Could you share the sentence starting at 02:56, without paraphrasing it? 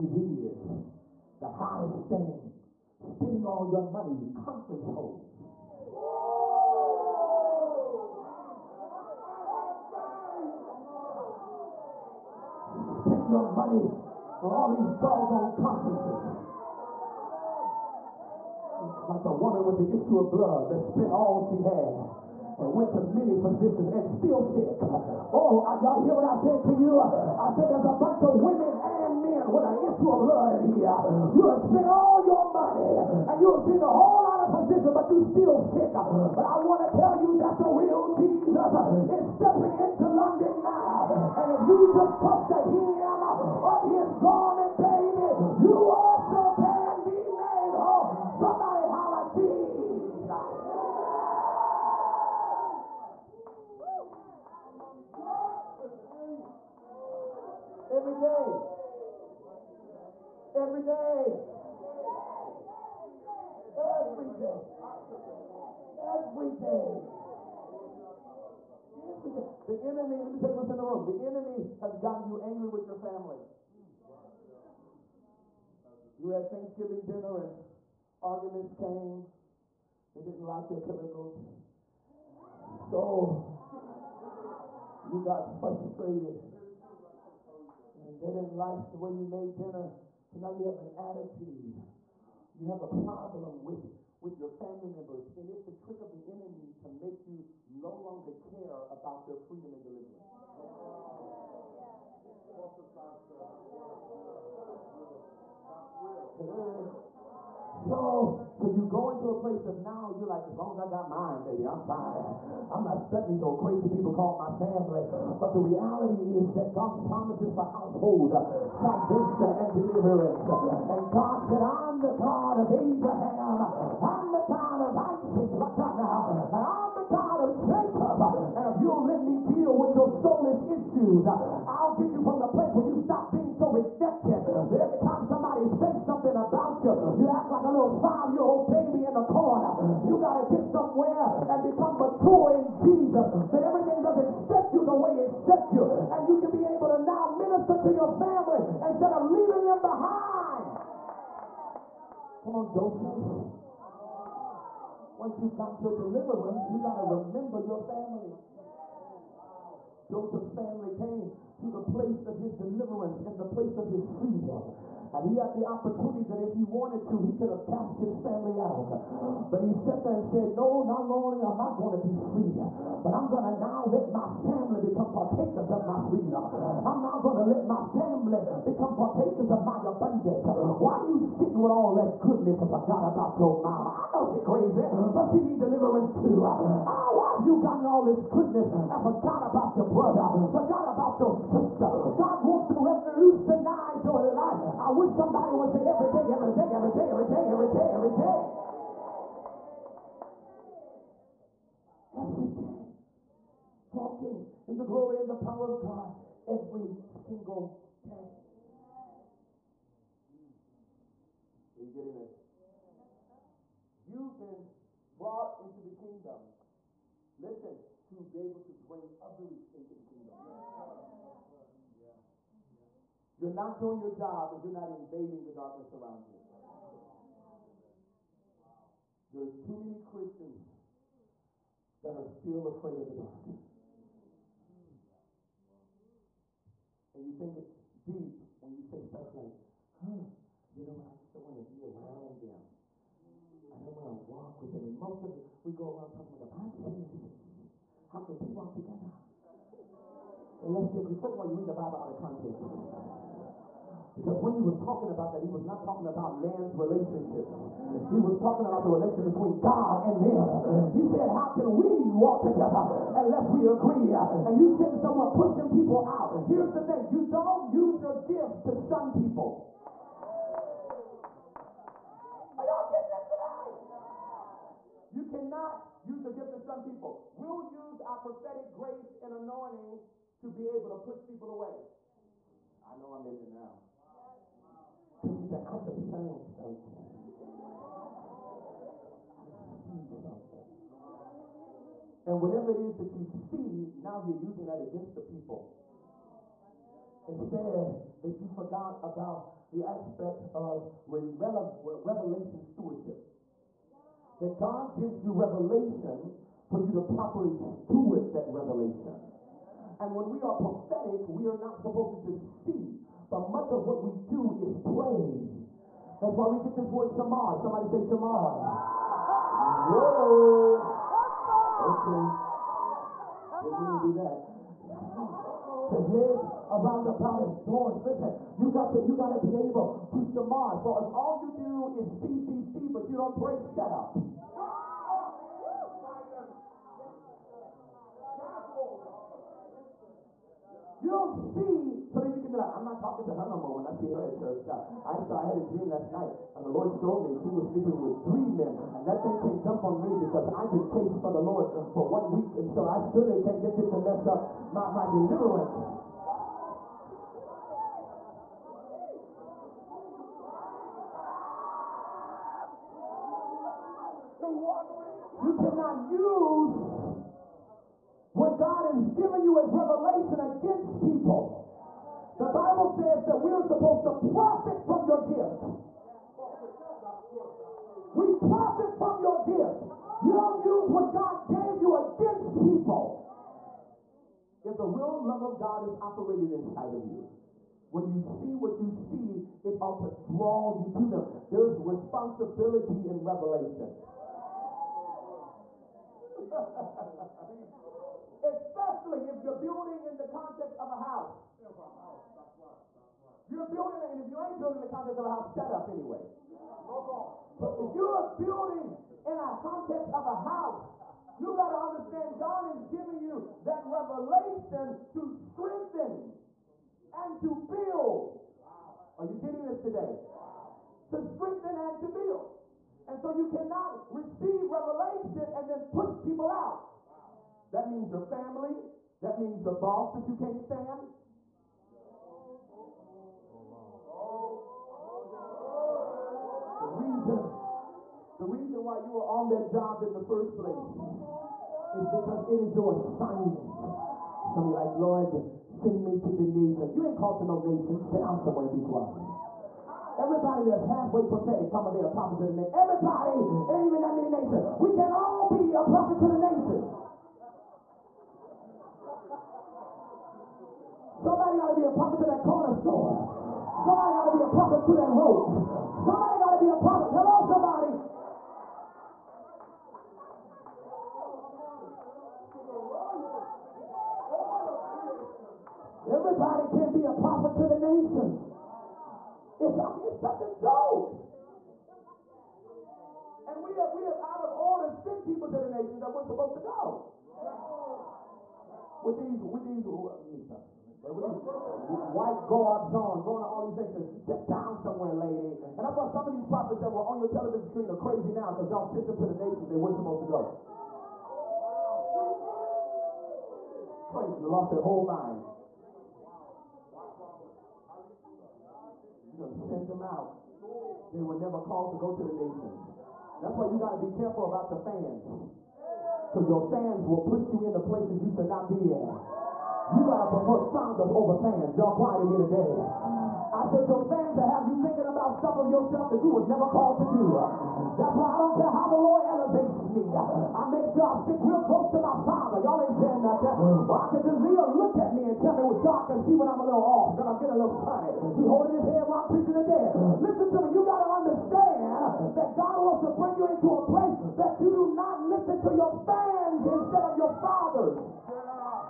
I'm now going to let my family become partakers of my abundance.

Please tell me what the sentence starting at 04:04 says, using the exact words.
And most of it, we go around talking about the Bible says, how can two walk together?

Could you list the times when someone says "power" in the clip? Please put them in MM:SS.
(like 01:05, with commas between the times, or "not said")
03:25.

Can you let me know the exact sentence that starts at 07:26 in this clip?
You ain't called to no nation.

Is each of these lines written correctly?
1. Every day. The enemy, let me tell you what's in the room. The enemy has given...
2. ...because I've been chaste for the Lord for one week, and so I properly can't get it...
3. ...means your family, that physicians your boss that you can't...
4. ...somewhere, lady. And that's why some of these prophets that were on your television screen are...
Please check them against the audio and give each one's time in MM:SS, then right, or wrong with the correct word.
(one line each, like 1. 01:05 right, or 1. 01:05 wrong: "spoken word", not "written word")
1. 01:06 wrong: "gotten", not "given"
2. 05:50 wrong: "surely", not "properly"
3. 07:07 wrong: "means", not "physicians"
4. 08:14 right.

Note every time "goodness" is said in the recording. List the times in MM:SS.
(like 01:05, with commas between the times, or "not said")
03:02, 03:08.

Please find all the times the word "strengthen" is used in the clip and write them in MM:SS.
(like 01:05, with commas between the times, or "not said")
06:55, 07:01.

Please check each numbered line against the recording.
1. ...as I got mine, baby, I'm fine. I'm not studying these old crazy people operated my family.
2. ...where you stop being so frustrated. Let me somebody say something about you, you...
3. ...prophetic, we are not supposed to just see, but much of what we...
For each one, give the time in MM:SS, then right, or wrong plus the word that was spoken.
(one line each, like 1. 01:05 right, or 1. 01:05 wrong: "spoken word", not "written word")
1. 01:50 wrong: "called", not "operated"
2. 02:12 wrong: "rejected", not "frustrated"
3. 05:10 right.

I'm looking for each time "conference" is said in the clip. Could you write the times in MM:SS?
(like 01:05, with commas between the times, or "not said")
00:04, 00:15.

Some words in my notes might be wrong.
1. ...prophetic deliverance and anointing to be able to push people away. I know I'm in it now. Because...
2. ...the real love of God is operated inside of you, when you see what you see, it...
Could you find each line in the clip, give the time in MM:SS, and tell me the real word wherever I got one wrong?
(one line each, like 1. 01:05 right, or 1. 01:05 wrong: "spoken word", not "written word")
1. 04:38 wrong: "grace", not "deliverance"
2. 06:24 right.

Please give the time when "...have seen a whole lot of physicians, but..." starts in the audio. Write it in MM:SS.
00:33.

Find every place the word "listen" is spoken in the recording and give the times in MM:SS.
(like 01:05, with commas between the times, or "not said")
03:37, 05:28, 09:00, 09:05.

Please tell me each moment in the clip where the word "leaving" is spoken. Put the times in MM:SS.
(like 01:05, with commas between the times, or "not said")
02:29.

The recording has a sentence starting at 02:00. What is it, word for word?
And God said, I'm the God of Abraham.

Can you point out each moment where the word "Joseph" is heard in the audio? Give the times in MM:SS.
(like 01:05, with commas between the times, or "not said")
02:32, 02:40.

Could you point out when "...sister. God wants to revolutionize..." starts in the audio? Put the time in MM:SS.
03:11.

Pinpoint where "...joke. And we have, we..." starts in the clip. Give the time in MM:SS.
08:00.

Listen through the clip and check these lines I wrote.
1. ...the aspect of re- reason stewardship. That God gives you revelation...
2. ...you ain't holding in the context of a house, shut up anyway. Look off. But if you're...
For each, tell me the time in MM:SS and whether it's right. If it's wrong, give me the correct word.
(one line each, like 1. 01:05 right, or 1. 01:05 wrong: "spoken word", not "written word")
1. 04:59 wrong: "revelation", not "reason"
2. 06:44 wrong: "building", not "holding".